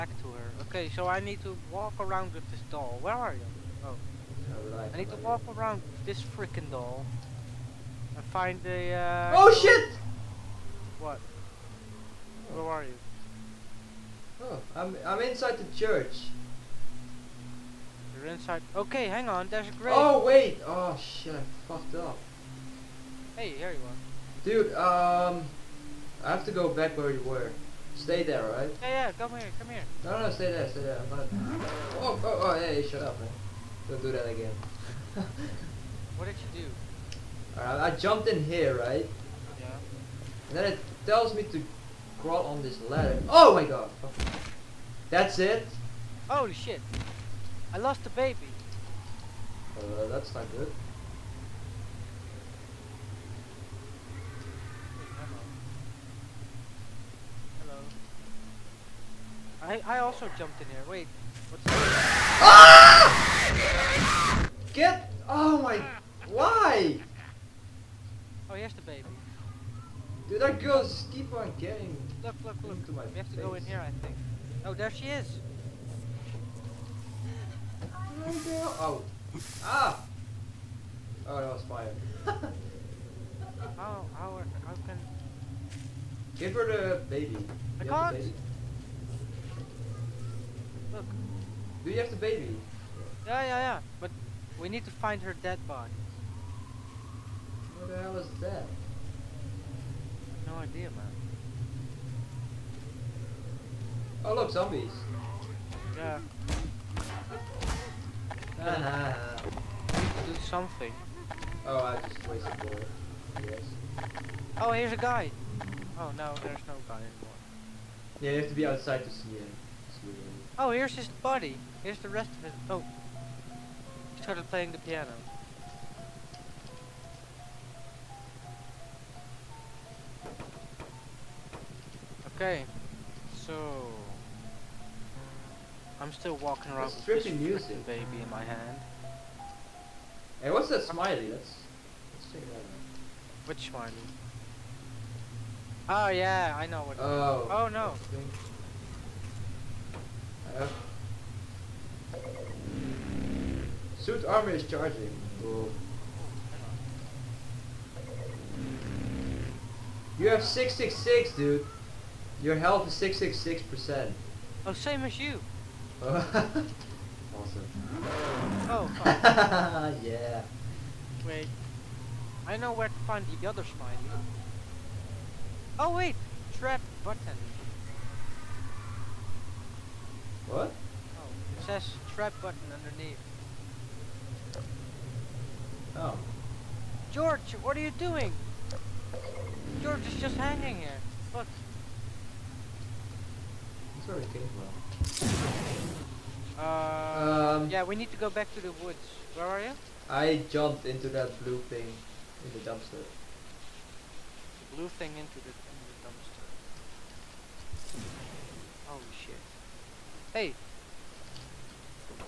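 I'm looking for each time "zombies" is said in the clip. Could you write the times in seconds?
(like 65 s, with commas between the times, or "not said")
104 s.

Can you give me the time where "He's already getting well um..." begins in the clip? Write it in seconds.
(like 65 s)
193 s.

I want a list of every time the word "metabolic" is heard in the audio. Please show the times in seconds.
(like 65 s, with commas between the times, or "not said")
not said.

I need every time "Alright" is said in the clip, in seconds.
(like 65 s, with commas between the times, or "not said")
37 s.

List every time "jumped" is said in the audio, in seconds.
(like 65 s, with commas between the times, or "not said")
37 s, 60 s, 200 s.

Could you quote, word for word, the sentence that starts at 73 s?
We have to go in here, I think.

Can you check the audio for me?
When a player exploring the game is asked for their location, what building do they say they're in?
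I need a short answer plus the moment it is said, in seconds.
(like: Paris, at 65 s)
Church, at 15 s.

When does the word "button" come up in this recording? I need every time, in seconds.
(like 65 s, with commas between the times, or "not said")
177 s, 182 s.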